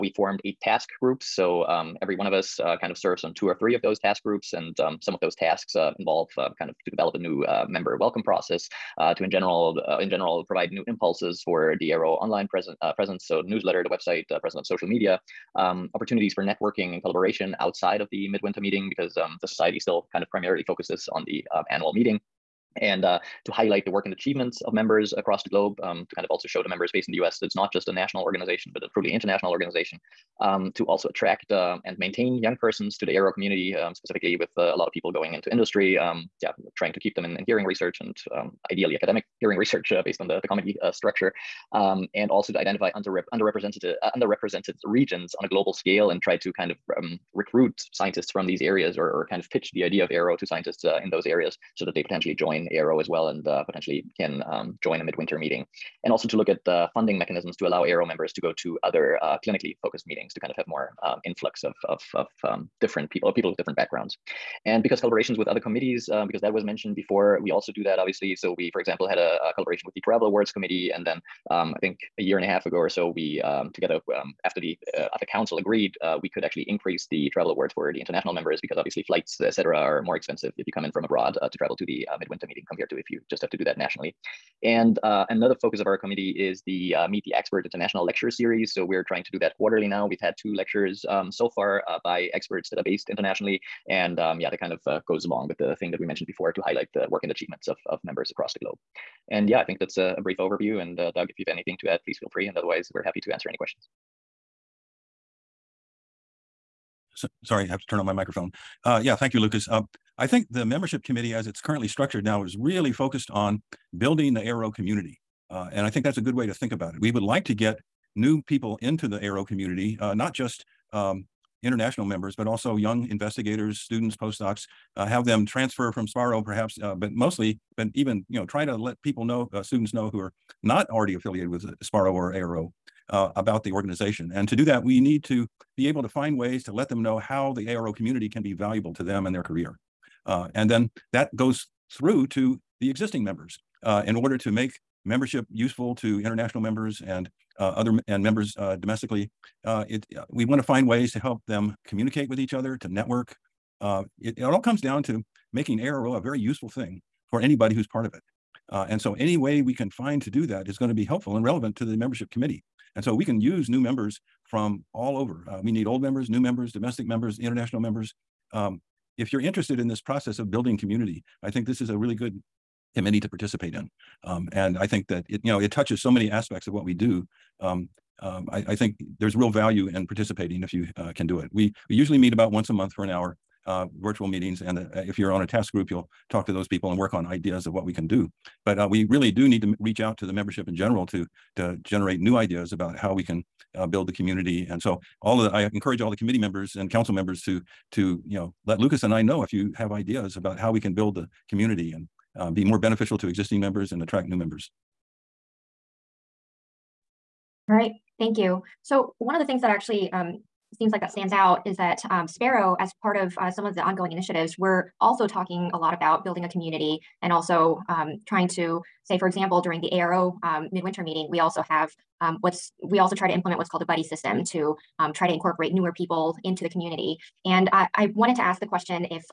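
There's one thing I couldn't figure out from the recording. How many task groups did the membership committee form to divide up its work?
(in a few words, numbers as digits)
8.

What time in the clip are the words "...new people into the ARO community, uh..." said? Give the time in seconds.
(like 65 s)
118 s.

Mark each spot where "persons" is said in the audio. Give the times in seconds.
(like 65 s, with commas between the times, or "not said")
32 s.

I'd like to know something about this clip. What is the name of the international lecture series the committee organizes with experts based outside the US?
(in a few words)
Meet the Expert.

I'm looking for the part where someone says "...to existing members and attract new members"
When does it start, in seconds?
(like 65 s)
203 s.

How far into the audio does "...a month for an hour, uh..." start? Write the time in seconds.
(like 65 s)
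182 s.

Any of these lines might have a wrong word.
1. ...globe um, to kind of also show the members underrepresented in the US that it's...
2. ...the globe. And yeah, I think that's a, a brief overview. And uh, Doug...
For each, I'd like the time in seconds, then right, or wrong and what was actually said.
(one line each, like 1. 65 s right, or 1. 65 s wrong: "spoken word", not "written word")
1. 25 s wrong: "based", not "underrepresented"
2. 98 s right.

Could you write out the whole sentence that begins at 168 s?
Um, if you're interested in this process of building community, I think this is a really good committee to participate in.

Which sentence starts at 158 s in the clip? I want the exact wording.
Uh, and so, any way we can find to do that is going to be helpful and relevant to the membership committee.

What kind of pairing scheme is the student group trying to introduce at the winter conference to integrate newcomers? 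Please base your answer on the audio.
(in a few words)
Buddy system.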